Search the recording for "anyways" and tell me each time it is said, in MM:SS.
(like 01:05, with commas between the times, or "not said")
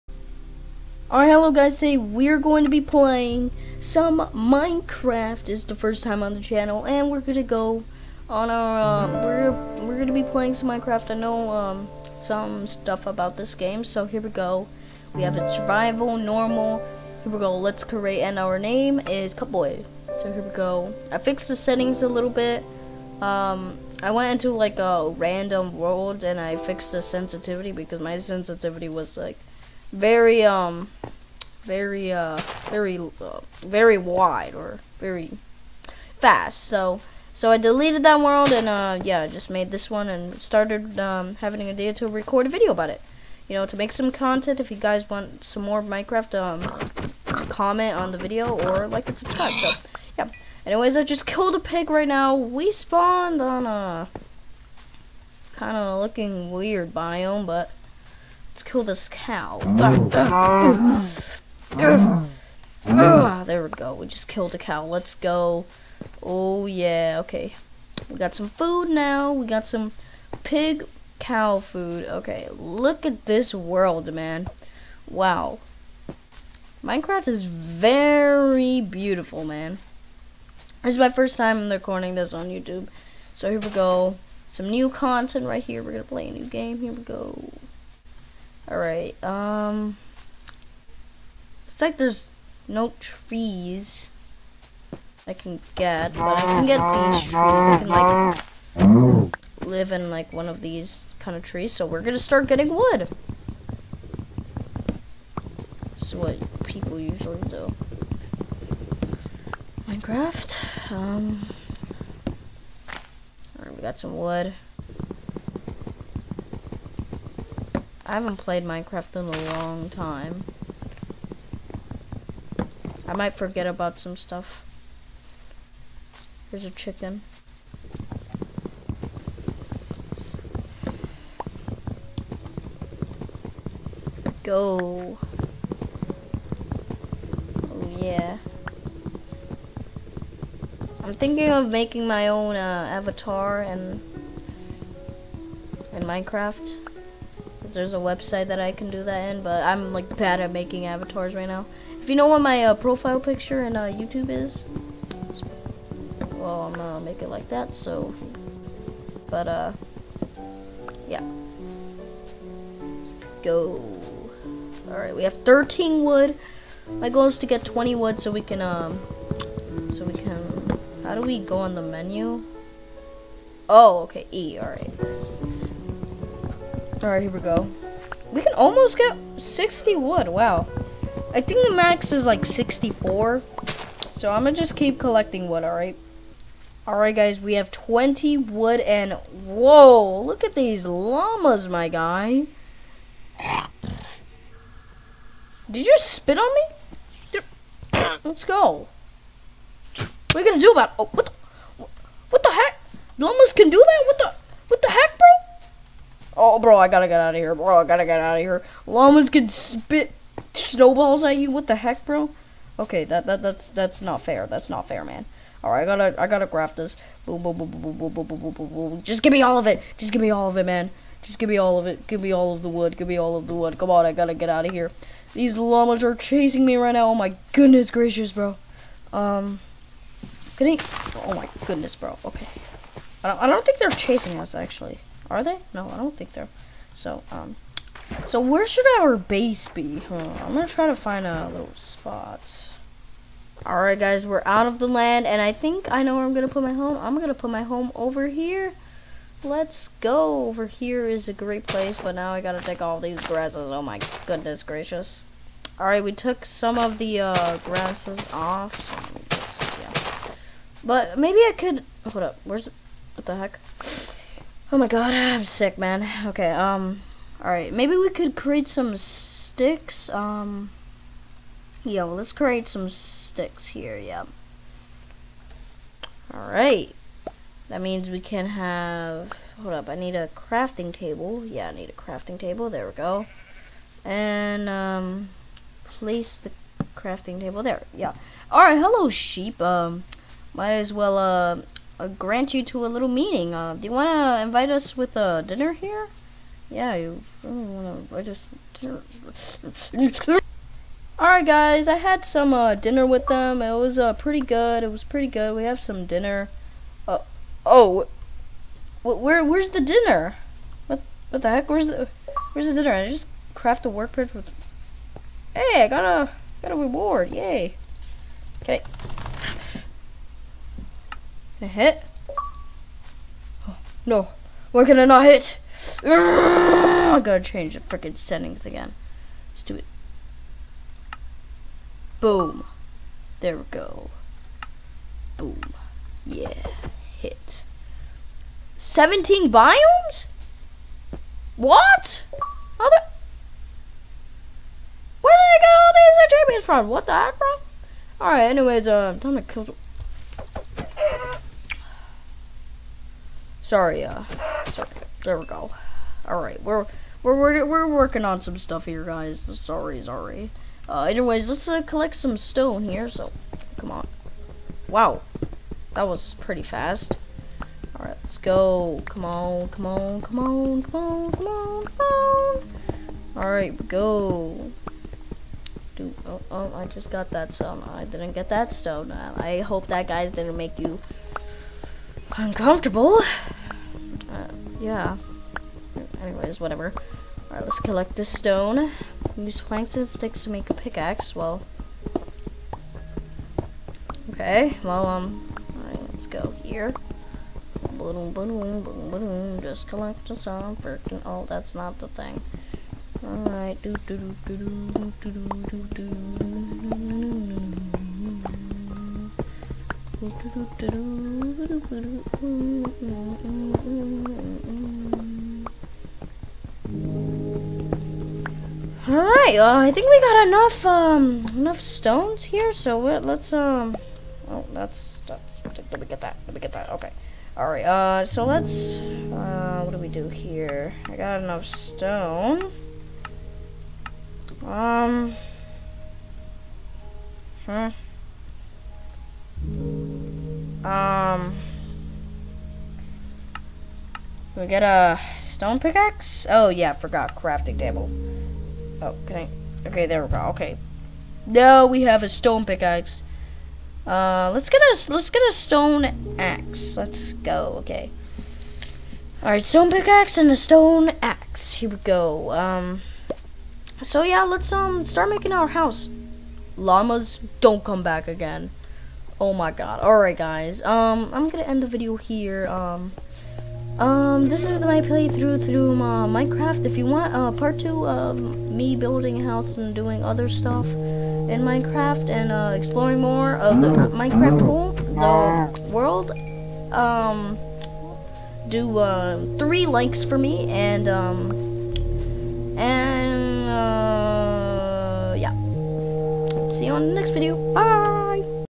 00:50, 05:48, 06:01.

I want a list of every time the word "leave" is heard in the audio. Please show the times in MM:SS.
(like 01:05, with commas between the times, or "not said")
not said.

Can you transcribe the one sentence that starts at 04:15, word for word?
Alright, we took some of the uh, grasses off.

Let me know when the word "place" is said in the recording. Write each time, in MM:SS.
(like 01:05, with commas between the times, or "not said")
04:11, 04:45.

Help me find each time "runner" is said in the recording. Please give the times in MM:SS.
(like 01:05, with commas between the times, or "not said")
not said.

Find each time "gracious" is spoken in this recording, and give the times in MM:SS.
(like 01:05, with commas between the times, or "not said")
03:47, 04:14.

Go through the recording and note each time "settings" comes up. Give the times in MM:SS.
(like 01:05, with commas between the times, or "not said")
00:21, 05:28.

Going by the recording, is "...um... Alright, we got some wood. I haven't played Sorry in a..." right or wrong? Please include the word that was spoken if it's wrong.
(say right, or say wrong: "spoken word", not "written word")
wrong: "Minecraft", not "Sorry".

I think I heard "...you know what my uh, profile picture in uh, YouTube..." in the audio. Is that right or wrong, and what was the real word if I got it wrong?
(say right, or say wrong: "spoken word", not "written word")
right.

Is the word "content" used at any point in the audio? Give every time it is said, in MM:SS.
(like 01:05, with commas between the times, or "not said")
00:44, 01:24.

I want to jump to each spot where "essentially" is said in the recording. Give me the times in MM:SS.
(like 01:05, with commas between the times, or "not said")
not said.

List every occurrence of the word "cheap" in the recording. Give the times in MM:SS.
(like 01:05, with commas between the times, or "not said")
not said.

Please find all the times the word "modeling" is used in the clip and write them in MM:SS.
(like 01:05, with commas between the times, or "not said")
not said.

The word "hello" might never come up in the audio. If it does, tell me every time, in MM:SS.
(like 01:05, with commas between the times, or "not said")
00:01, 04:48.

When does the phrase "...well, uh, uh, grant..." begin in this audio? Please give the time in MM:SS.
04:50.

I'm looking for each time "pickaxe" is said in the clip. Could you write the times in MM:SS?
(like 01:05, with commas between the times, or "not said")
07:25, 07:32, 07:39.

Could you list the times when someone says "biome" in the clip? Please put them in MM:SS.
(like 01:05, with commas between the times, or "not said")
00:56, 05:39.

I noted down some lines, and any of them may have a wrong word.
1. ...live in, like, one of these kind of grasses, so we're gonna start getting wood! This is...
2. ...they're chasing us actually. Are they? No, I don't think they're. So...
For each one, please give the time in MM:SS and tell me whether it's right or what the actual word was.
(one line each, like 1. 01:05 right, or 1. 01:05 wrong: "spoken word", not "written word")
1. 01:39 wrong: "trees", not "grasses"
2. 03:53 right.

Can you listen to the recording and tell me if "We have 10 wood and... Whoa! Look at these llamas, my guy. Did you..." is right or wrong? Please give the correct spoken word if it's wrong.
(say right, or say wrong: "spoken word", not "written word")
wrong: "20", not "10".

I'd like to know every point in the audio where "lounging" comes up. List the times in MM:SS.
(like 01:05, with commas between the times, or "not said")
not said.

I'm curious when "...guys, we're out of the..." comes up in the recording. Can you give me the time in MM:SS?
04:03.